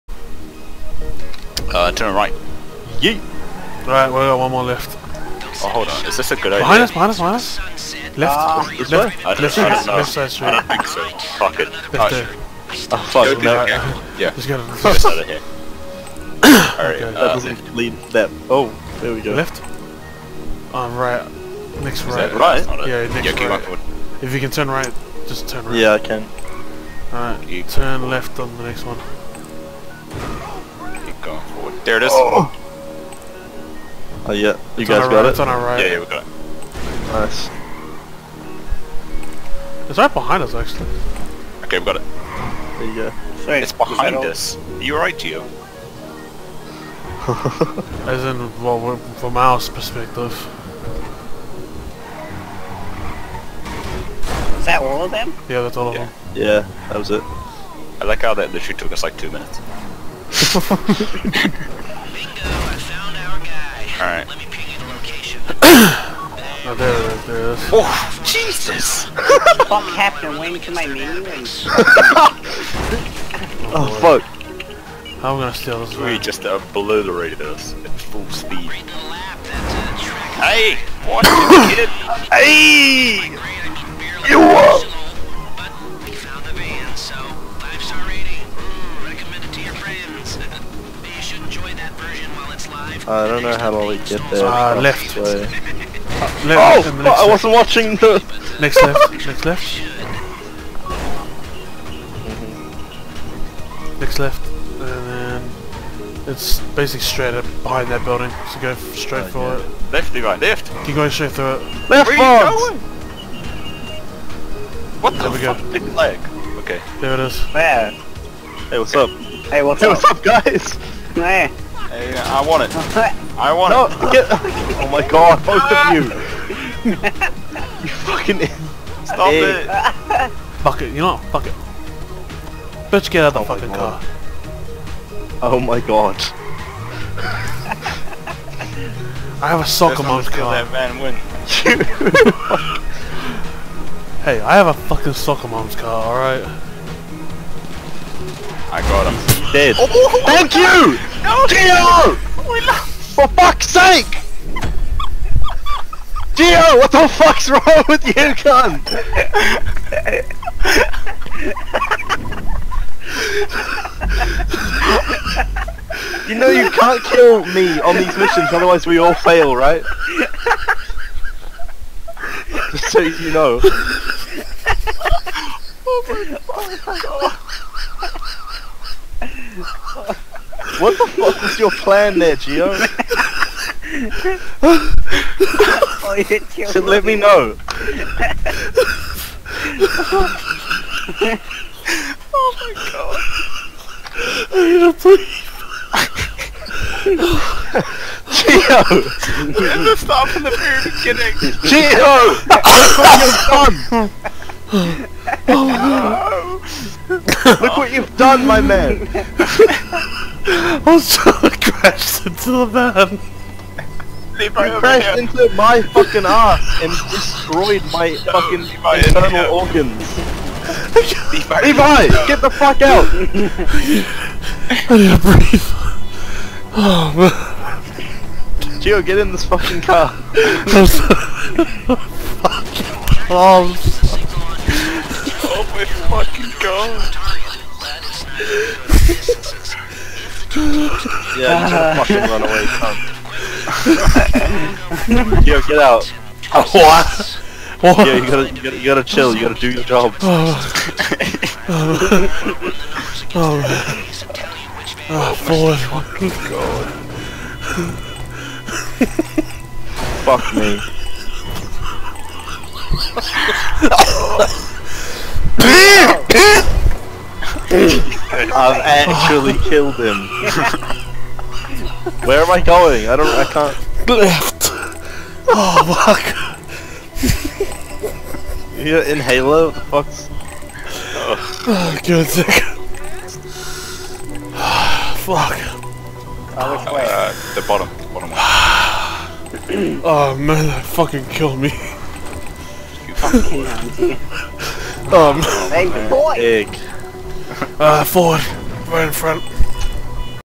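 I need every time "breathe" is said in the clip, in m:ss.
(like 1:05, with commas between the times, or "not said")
3:45.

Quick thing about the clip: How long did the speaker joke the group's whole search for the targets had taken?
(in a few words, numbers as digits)
2 minutes.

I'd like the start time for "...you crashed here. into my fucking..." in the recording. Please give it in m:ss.
3:34.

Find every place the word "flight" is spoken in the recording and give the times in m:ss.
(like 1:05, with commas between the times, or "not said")
not said.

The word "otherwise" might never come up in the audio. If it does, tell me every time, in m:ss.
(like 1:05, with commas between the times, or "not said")
2:48.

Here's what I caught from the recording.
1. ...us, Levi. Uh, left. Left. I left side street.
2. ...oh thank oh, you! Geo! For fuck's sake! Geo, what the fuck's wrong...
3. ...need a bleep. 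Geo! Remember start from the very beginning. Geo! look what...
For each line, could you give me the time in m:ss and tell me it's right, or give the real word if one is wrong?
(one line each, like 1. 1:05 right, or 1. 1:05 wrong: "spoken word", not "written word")
1. 0:07 wrong: "Left", not "Levi"
2. 2:30 right
3. 3:14 right.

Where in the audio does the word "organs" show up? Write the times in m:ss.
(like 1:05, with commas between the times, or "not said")
3:39.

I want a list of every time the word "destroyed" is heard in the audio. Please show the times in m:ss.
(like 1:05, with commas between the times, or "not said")
3:37.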